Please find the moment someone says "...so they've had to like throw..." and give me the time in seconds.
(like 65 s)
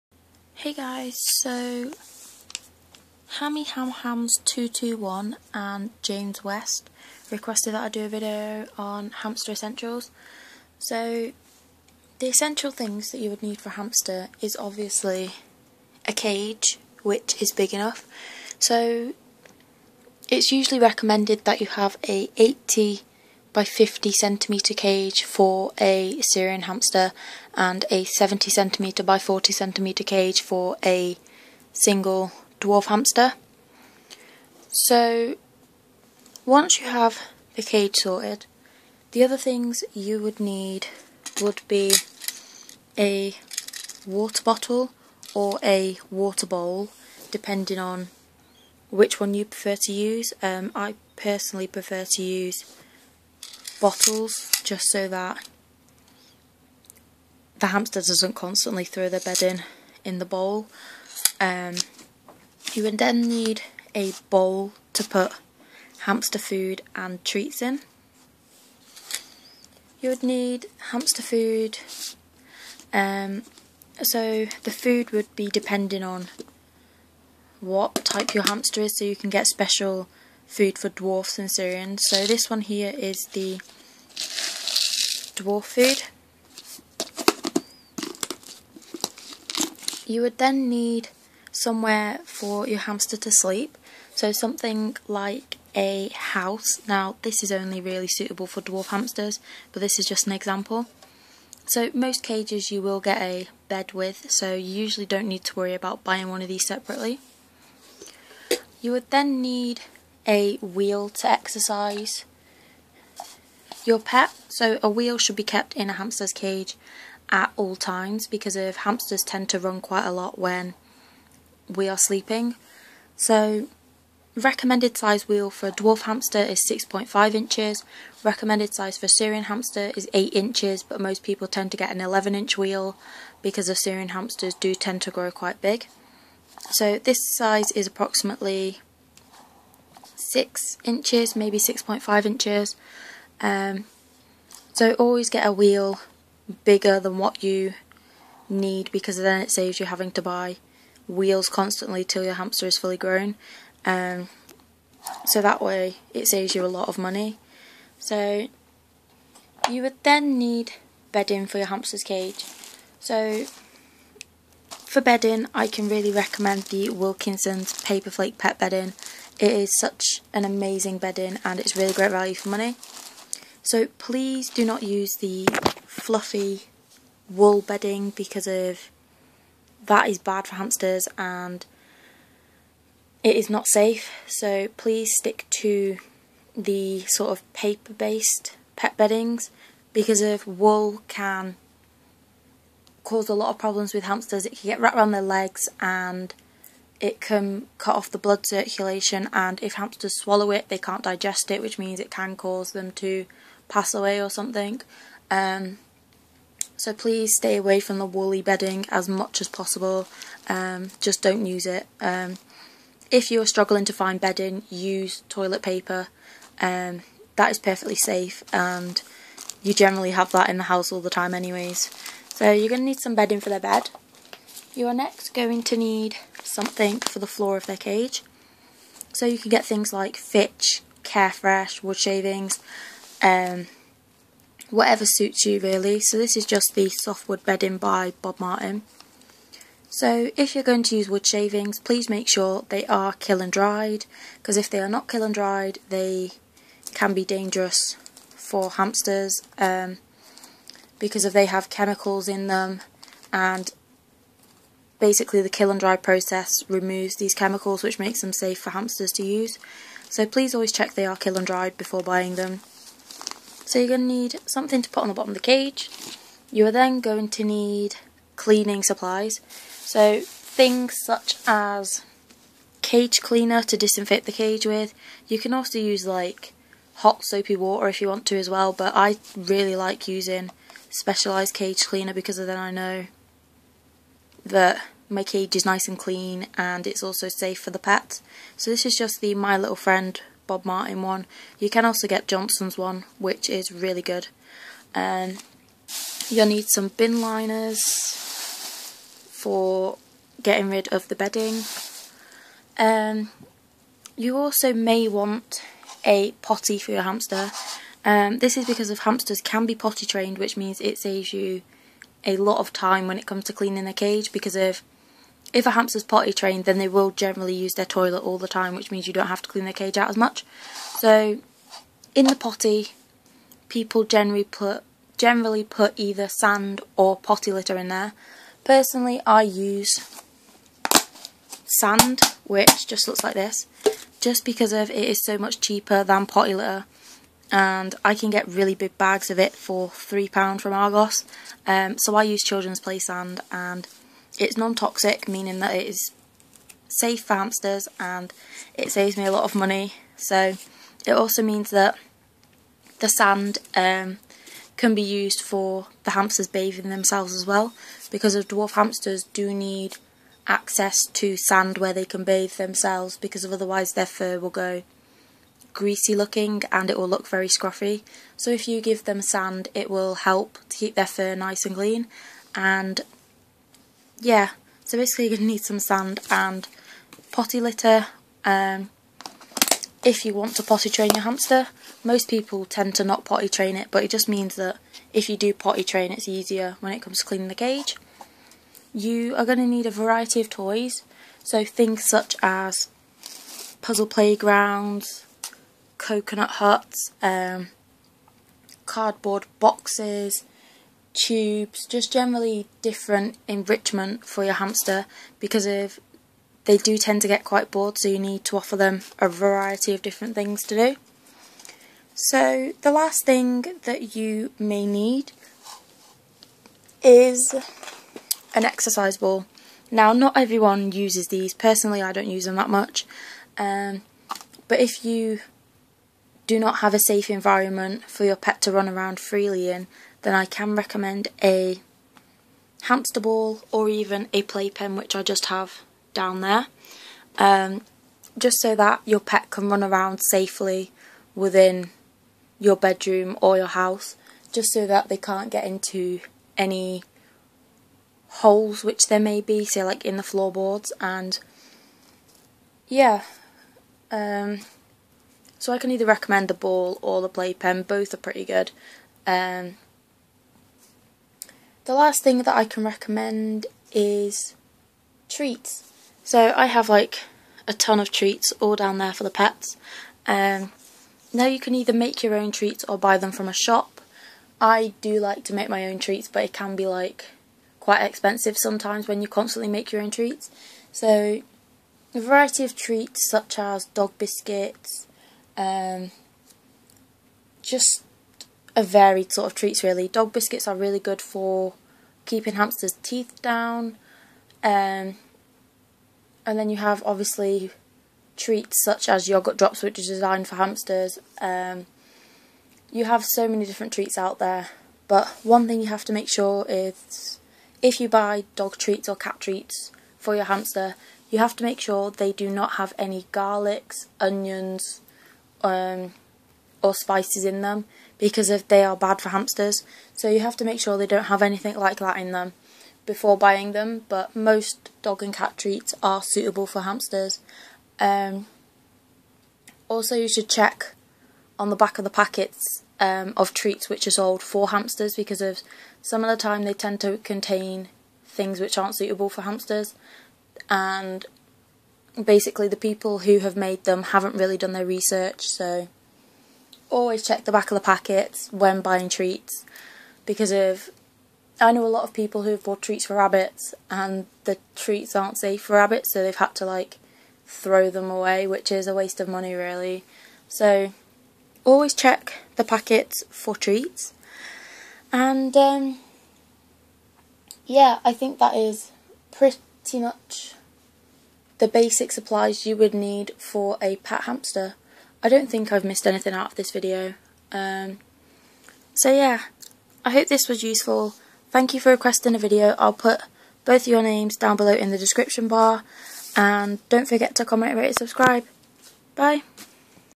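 556 s.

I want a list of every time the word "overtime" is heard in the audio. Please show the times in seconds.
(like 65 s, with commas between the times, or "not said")
not said.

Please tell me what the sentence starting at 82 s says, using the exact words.
So this one here is the dwarf food.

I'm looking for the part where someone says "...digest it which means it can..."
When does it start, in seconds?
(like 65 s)
201 s.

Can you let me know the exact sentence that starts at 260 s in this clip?
So please always check they are kiln dried before buying them.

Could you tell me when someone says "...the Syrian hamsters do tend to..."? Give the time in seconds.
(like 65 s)
133 s.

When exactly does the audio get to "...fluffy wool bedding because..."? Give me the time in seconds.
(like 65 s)
175 s.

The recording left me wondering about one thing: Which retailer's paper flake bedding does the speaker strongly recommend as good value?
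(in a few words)
Wilkinson's.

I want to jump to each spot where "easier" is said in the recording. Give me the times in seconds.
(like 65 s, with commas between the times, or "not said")
386 s.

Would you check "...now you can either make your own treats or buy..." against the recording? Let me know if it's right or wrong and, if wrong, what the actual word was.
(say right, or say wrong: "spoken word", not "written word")
right.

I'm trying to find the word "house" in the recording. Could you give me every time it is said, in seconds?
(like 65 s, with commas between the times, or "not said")
96 s, 220 s, 443 s.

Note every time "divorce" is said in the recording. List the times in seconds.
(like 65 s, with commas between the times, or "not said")
not said.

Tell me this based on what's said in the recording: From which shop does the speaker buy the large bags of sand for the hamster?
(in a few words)
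Argos.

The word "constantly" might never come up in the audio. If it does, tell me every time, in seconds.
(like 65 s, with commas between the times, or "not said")
58 s, 151 s, 479 s.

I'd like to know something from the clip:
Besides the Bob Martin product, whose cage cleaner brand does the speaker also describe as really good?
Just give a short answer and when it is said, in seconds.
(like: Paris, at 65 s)
Johnson's, at 292 s.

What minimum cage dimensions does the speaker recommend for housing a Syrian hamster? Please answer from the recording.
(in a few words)
80 by 50 cm.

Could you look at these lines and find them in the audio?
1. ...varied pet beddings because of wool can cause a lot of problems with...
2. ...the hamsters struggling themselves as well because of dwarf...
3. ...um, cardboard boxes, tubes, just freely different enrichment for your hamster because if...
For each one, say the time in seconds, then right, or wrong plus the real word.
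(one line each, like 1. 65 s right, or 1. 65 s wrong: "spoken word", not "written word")
1. 187 s wrong: "based", not "varied"
2. 356 s wrong: "bathing", not "struggling"
3. 397 s wrong: "generally", not "freely".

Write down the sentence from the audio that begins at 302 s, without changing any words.
Um, you also may want a potty for your hamster.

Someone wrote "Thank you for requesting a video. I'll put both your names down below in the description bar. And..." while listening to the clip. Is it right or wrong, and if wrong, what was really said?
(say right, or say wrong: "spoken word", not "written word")
right.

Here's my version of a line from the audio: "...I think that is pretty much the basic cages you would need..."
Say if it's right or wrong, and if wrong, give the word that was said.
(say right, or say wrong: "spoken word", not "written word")
wrong: "supplies", not "cages".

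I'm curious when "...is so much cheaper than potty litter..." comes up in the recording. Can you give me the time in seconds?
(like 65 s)
335 s.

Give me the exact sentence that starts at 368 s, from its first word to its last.
So if you give them sand, it will help to keep their fur nice and clean.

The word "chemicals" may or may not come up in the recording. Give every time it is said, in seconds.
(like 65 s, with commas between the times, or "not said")
251 s, 257 s.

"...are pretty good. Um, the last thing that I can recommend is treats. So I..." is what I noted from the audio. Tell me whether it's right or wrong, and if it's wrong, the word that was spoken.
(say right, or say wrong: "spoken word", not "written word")
right.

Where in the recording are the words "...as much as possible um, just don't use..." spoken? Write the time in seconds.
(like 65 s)
208 s.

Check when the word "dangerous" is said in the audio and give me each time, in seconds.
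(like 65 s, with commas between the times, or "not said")
247 s.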